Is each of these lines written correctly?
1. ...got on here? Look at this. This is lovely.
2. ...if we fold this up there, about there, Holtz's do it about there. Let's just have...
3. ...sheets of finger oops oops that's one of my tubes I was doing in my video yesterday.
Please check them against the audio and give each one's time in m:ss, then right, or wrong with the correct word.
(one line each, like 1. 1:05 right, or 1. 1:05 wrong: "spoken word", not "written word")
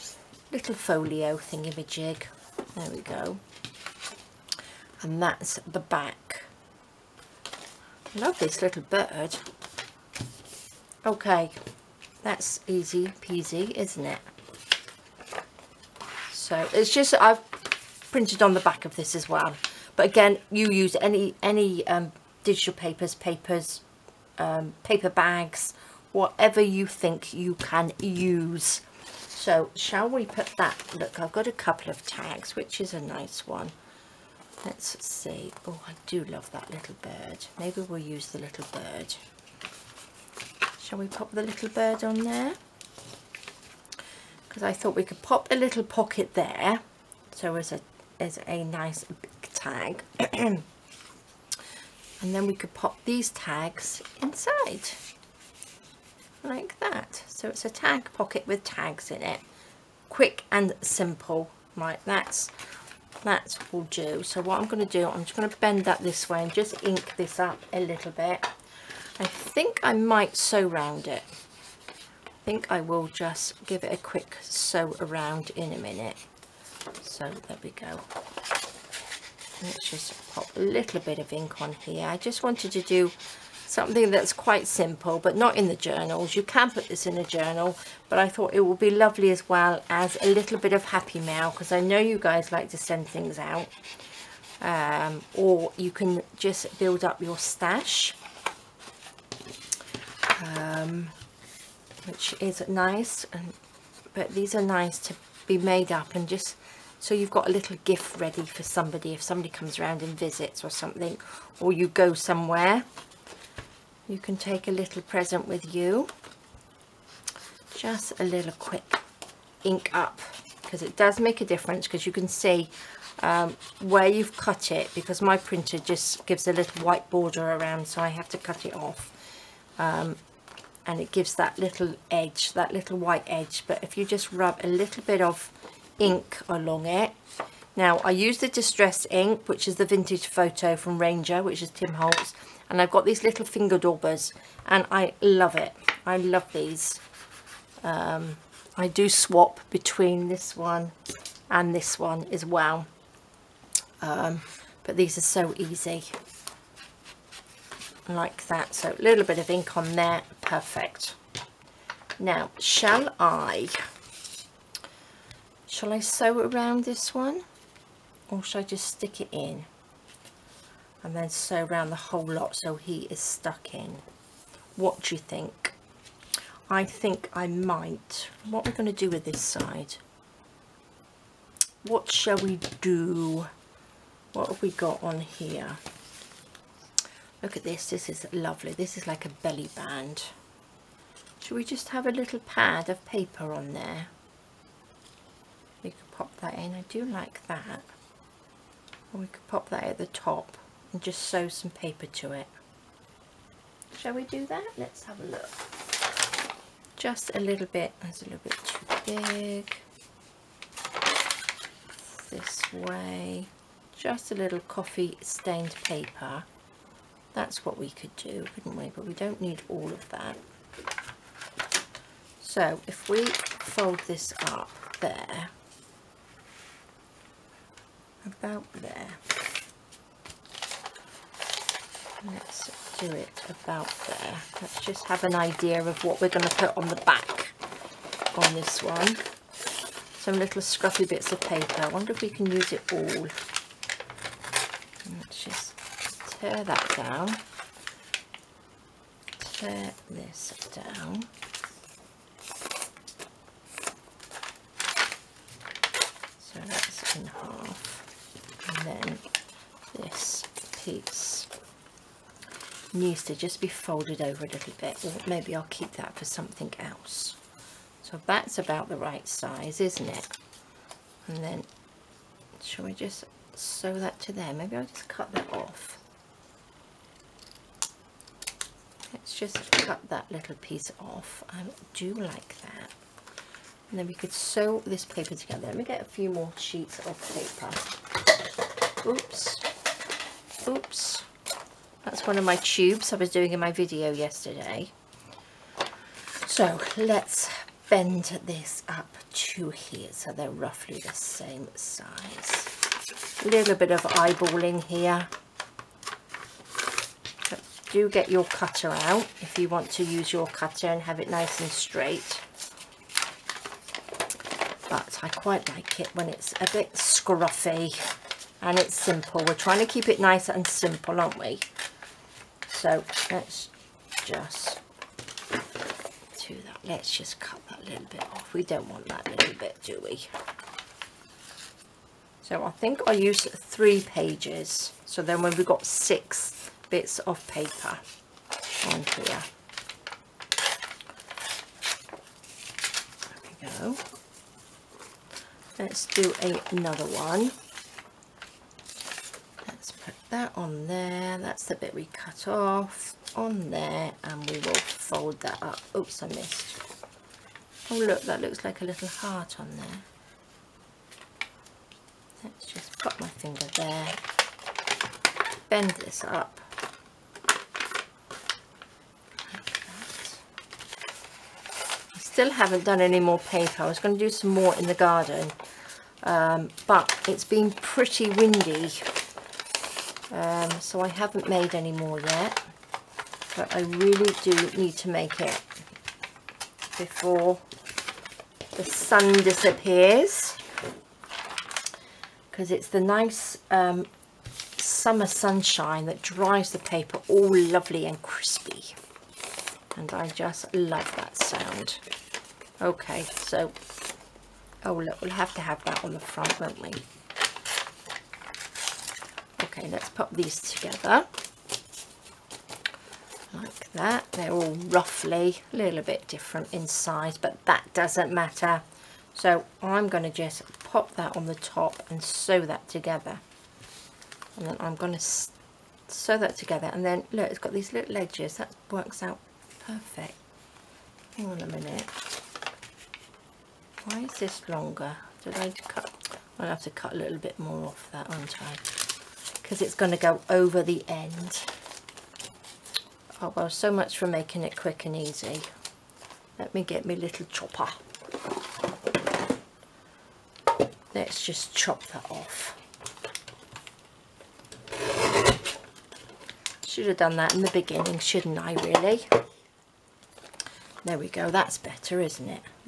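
1. 3:04 right
2. 3:42 wrong: "Let", not "Holtz"
3. 4:46 wrong: "paper", not "finger".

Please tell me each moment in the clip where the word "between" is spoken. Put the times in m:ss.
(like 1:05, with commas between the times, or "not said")
2:29.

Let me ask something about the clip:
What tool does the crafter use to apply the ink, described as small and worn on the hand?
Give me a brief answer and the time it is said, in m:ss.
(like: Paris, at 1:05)
finger daubers, at 2:23.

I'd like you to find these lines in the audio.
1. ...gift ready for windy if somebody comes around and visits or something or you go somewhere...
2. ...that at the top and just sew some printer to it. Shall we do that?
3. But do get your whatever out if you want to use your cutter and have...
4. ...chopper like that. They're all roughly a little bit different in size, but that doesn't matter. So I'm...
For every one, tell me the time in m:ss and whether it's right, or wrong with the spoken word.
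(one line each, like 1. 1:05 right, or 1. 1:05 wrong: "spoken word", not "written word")
1. 1:47 wrong: "somebody", not "windy"
2. 3:19 wrong: "paper", not "printer"
3. 5:07 wrong: "cutter", not "whatever"
4. 6:50 wrong: "together", not "chopper".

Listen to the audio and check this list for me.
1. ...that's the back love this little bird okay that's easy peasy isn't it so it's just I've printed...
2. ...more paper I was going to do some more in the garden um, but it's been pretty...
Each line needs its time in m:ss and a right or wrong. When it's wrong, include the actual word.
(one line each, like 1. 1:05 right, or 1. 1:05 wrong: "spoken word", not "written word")
1. 0:05 right
2. 6:13 right.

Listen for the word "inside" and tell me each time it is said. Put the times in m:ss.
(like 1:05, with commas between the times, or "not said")
0:54.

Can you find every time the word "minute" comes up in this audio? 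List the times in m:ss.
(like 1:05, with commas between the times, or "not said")
1:15, 7:11.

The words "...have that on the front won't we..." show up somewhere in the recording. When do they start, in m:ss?
6:45.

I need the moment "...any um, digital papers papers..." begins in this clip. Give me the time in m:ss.
0:21.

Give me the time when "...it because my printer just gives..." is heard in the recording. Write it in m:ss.
2:04.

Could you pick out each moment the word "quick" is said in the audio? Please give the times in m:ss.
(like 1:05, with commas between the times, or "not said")
1:00, 1:13, 1:58, 7:24.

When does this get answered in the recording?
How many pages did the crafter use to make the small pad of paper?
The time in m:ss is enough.
5:33.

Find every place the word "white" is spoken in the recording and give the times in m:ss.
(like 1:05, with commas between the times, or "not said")
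2:06, 2:12.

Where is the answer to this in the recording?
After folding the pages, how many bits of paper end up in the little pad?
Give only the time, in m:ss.
5:35.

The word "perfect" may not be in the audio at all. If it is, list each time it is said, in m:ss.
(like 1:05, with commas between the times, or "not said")
2:40, 7:09.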